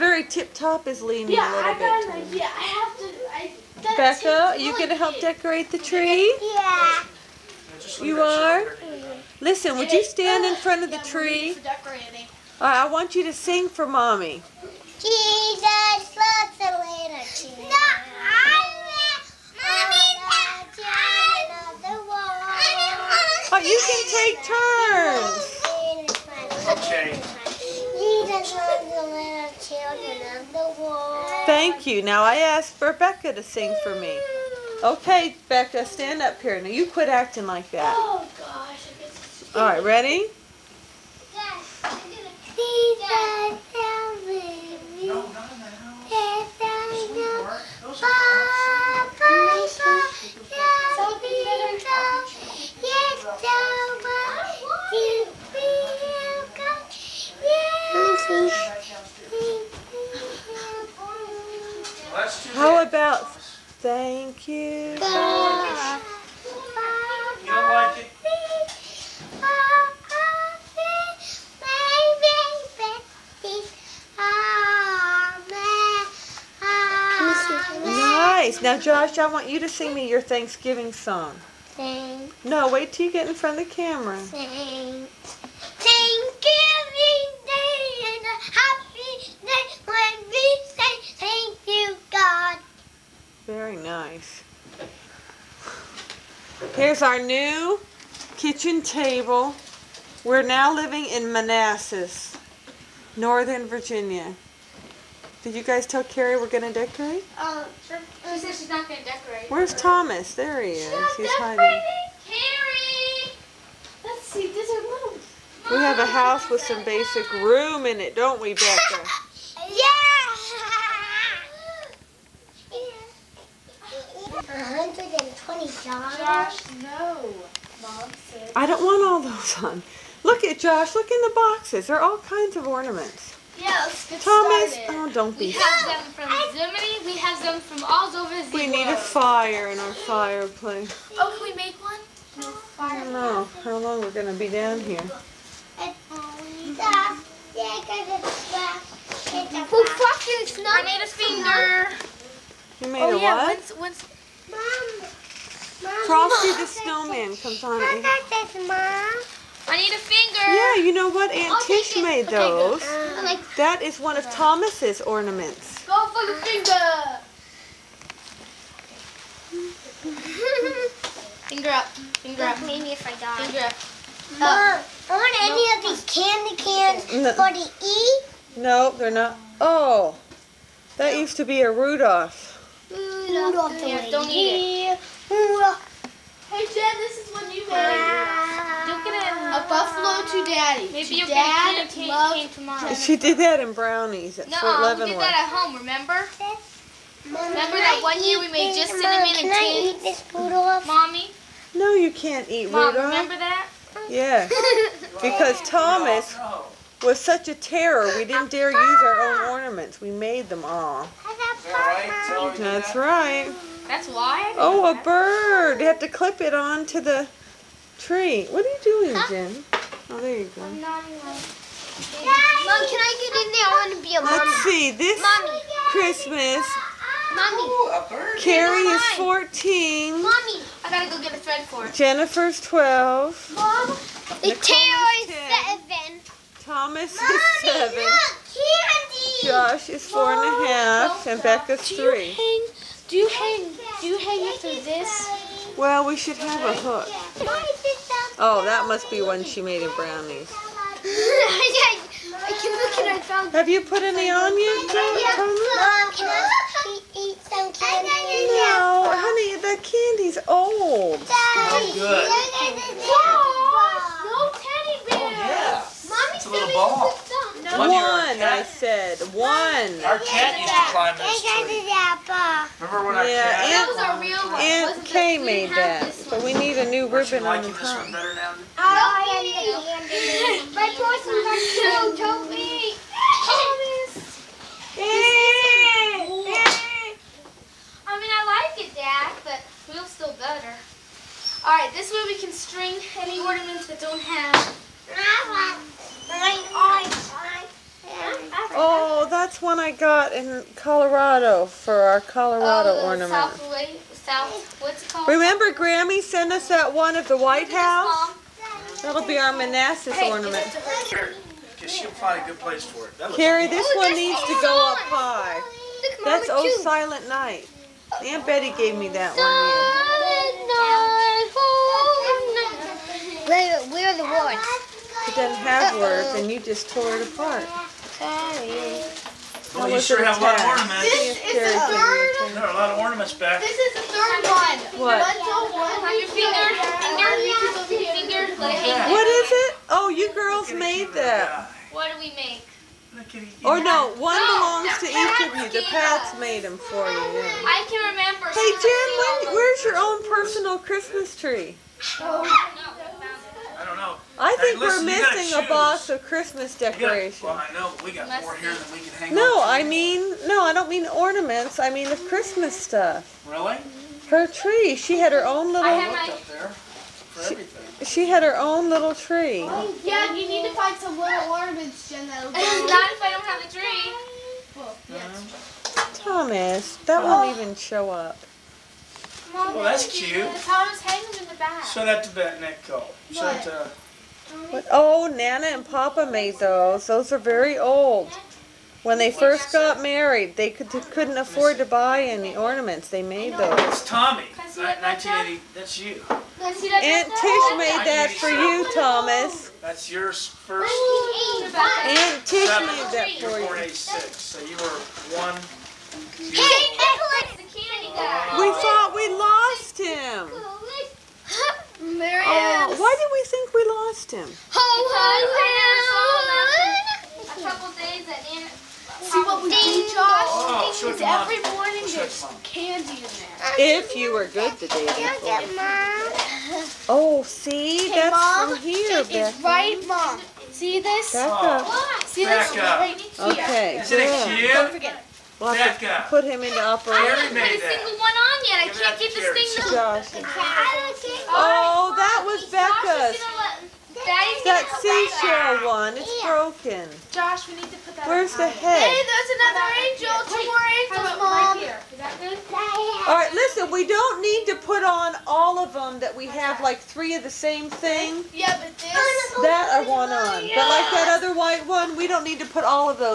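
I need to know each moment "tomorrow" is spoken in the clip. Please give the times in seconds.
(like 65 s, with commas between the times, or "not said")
192 s.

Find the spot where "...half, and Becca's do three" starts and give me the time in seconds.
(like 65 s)
240 s.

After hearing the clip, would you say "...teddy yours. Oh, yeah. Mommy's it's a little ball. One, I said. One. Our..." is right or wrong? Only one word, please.
wrong.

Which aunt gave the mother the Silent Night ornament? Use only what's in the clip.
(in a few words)
Aunt Betty.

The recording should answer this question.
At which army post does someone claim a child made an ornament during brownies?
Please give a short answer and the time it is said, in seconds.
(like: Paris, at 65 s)
Fort Leavenworth, at 194 s.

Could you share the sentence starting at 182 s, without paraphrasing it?
Rudolph, Rudolph the yeah, Don't eat it.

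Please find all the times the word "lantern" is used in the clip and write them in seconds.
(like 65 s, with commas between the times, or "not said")
16 s.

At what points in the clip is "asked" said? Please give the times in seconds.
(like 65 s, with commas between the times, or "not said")
32 s.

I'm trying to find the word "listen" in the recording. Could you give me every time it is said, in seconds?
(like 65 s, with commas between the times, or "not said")
9 s, 354 s, 453 s.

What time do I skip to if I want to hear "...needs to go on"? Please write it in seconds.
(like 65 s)
314 s.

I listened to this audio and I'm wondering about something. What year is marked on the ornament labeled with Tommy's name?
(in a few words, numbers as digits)
1980.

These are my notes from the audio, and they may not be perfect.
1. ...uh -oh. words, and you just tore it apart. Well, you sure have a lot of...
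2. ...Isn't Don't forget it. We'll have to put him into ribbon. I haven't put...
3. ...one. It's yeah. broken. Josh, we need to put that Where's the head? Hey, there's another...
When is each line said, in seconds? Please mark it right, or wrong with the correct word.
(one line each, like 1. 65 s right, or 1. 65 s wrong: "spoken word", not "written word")
1. 325 s right
2. 434 s wrong: "operation", not "ribbon"
3. 445 s right.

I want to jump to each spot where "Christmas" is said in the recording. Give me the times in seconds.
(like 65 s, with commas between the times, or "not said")
225 s, 350 s, 356 s, 362 s.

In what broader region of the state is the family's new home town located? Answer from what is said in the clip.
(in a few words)
Northern Virginia.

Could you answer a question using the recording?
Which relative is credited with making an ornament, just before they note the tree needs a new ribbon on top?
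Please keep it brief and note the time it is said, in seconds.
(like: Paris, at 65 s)
Aunt Kay, at 274 s.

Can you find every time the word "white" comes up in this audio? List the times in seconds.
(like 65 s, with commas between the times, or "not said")
307 s, 461 s.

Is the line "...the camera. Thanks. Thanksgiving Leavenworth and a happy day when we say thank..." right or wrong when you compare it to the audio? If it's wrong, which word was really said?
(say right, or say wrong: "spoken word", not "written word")
wrong: "Day", not "Leavenworth".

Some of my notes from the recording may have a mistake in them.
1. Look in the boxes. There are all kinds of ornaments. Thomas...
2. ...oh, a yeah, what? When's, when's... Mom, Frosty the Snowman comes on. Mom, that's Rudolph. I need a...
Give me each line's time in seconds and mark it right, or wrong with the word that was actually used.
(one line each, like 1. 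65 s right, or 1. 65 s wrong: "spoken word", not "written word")
1. 130 s right
2. 153 s wrong: "Mom", not "Rudolph".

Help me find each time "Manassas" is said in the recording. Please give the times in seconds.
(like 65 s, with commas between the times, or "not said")
101 s, 309 s.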